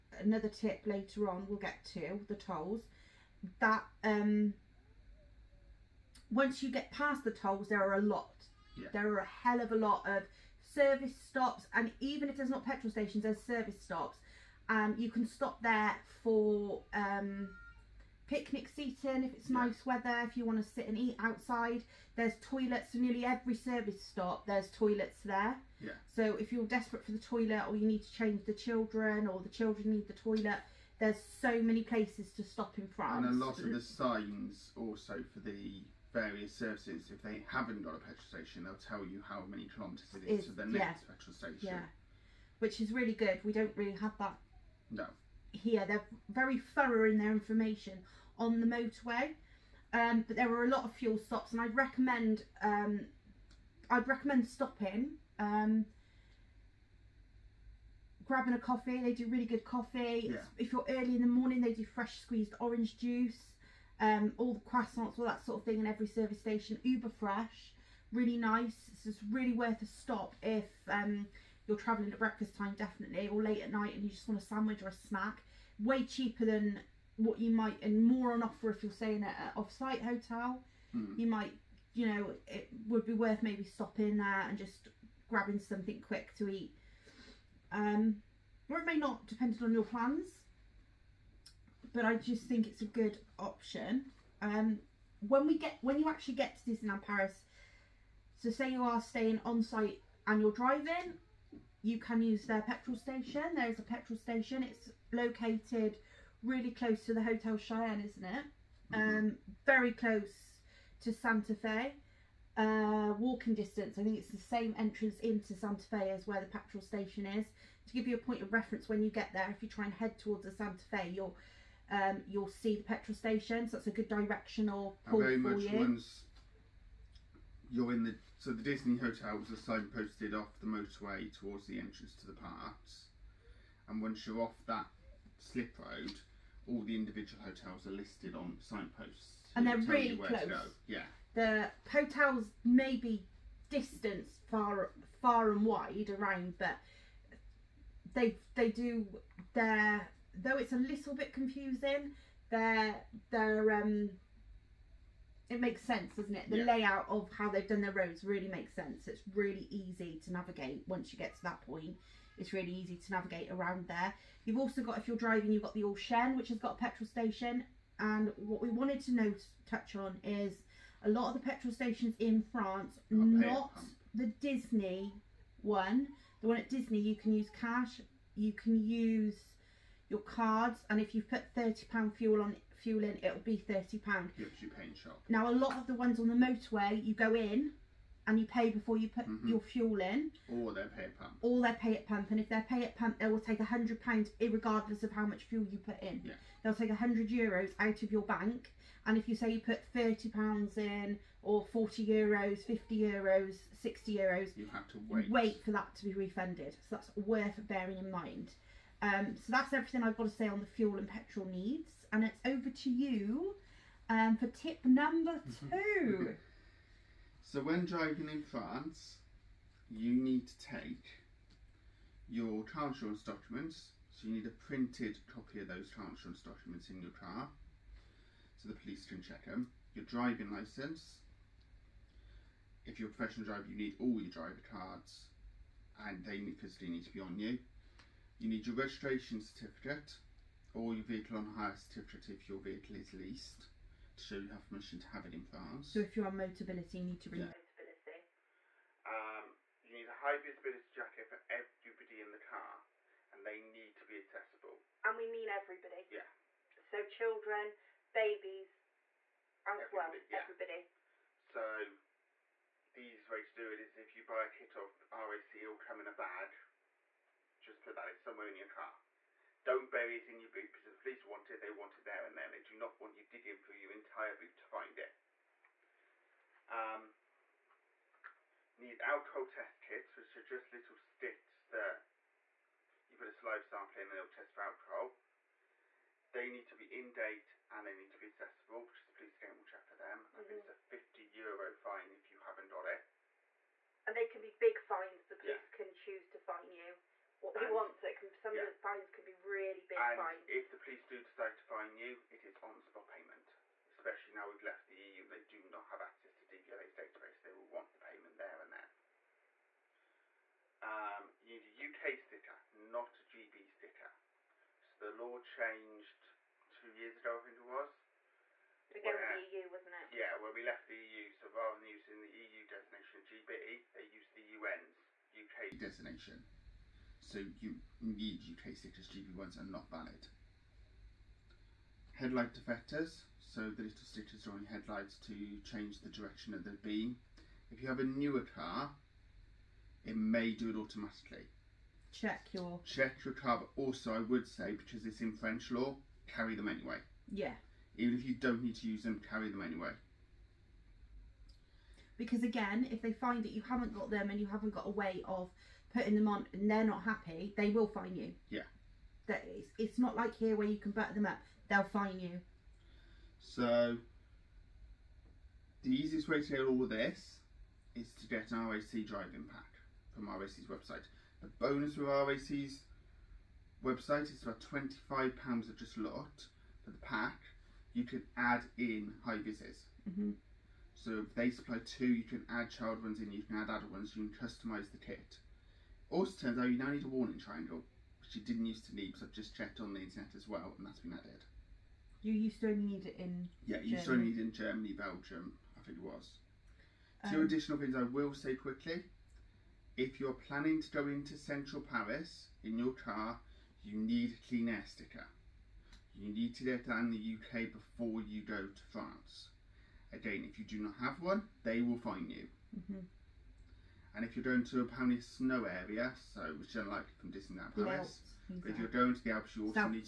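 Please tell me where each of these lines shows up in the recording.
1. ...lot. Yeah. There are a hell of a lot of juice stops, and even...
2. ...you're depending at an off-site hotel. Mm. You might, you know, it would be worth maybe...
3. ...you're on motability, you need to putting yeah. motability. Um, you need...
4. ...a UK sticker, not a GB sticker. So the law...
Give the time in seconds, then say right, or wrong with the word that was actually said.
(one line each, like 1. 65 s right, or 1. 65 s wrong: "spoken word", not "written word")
1. 8 s wrong: "service", not "juice"
2. 78 s wrong: "staying", not "depending"
3. 246 s wrong: "bring", not "putting"
4. 312 s right.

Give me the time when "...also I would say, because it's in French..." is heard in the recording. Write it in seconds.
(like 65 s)
343 s.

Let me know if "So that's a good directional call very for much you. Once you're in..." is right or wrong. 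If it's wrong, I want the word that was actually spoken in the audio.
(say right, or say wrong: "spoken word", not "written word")
right.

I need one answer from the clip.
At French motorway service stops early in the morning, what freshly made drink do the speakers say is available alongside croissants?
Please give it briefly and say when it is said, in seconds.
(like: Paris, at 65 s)
fresh squeezed orange juice, at 61 s.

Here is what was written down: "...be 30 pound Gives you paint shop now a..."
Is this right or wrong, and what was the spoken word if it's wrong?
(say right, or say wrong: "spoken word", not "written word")
right.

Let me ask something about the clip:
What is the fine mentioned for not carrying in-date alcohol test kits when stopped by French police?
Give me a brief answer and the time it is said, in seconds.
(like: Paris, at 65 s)
50 euros, at 290 s.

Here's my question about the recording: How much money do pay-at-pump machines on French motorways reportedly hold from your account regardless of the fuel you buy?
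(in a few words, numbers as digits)
100 euros.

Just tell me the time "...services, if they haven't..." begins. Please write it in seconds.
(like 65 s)
36 s.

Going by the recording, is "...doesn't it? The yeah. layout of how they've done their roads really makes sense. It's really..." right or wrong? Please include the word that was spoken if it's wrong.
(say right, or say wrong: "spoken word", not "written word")
right.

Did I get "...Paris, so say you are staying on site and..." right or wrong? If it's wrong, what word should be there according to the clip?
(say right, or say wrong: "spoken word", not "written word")
right.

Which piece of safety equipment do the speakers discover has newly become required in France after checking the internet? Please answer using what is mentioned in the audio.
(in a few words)
warning triangle.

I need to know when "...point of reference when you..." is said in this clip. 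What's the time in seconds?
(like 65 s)
118 s.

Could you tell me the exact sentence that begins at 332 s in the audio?
Headlight deflectors, so the little stickers are on your headlights to change the direction of the beam.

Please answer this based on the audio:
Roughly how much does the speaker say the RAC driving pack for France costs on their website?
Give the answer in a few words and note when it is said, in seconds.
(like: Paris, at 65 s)
£25, at 375 s.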